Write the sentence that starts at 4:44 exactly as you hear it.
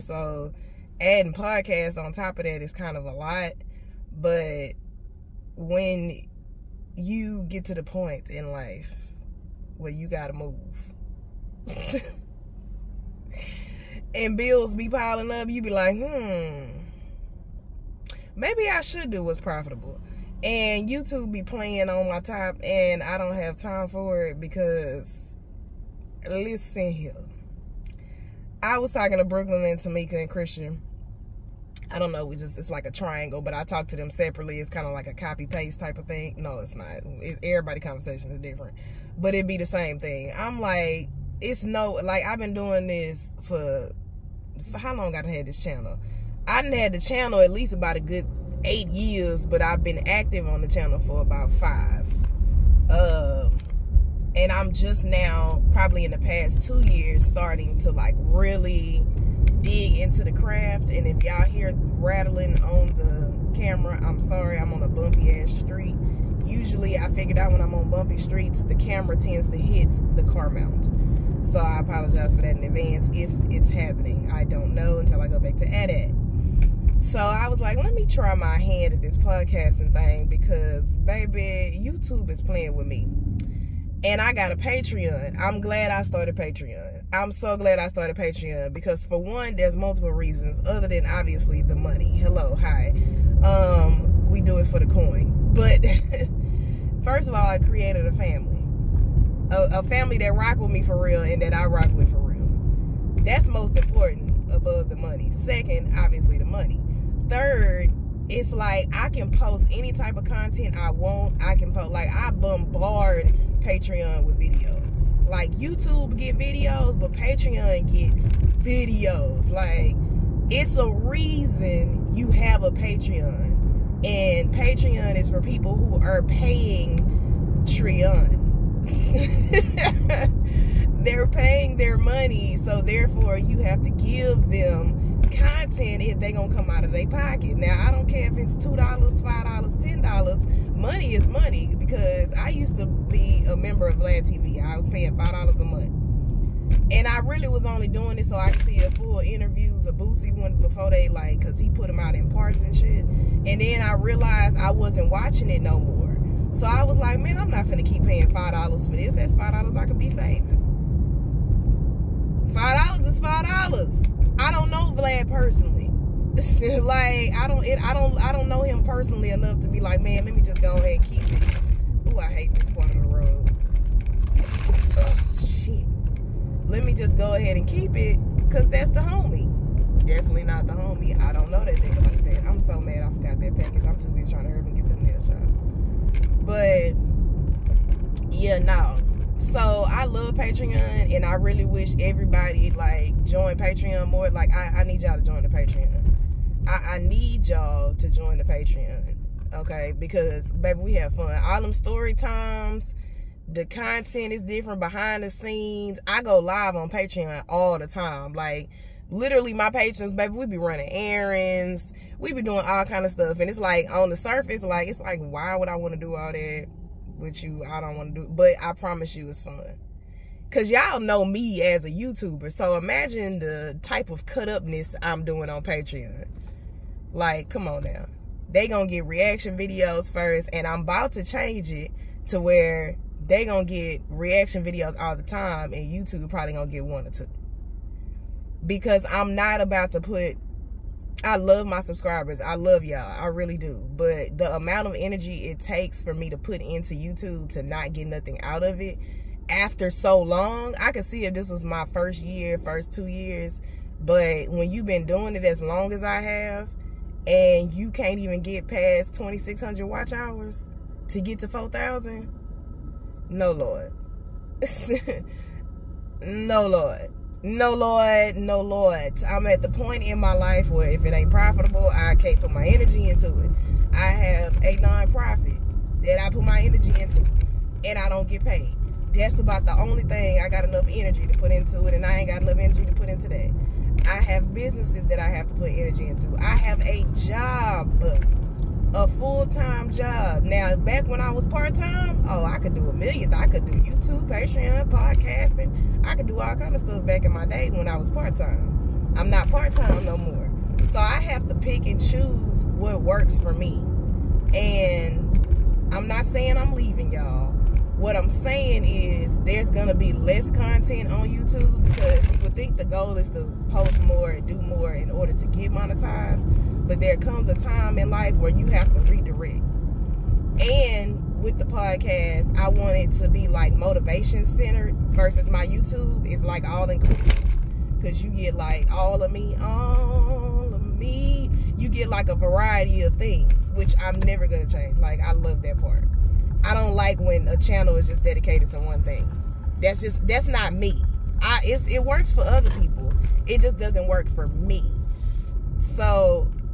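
I have businesses that I have to put energy into.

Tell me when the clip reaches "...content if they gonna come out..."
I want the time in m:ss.
2:15.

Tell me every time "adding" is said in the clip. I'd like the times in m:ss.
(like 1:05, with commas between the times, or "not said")
0:01.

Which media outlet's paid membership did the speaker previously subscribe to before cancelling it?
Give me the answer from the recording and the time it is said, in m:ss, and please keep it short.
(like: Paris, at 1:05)
Vlad TV, at 2:23.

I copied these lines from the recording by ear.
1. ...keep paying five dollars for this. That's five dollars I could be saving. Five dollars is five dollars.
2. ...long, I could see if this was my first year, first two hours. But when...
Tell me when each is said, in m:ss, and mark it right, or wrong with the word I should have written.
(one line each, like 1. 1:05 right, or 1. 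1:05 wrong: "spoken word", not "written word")
1. 2:37 right
2. 4:10 wrong: "years", not "hours".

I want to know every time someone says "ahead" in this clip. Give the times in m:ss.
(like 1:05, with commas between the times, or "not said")
2:50, 2:57.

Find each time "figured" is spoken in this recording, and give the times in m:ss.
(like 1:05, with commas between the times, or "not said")
1:07.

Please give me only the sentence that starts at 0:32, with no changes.
We just it's like a triangle, but I talk to them separately.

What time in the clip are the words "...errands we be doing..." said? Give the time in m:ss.
3:30.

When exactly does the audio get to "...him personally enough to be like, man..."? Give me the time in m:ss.
2:48.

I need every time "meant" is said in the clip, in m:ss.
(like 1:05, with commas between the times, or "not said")
not said.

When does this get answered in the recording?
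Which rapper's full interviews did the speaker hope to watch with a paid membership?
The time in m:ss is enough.
2:29.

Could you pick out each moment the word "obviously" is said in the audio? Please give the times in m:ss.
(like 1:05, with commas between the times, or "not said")
1:31, 1:45.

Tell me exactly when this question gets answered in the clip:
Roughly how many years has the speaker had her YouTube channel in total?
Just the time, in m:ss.
0:48.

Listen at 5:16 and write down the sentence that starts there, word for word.
But there comes a time in life where you have to redirect.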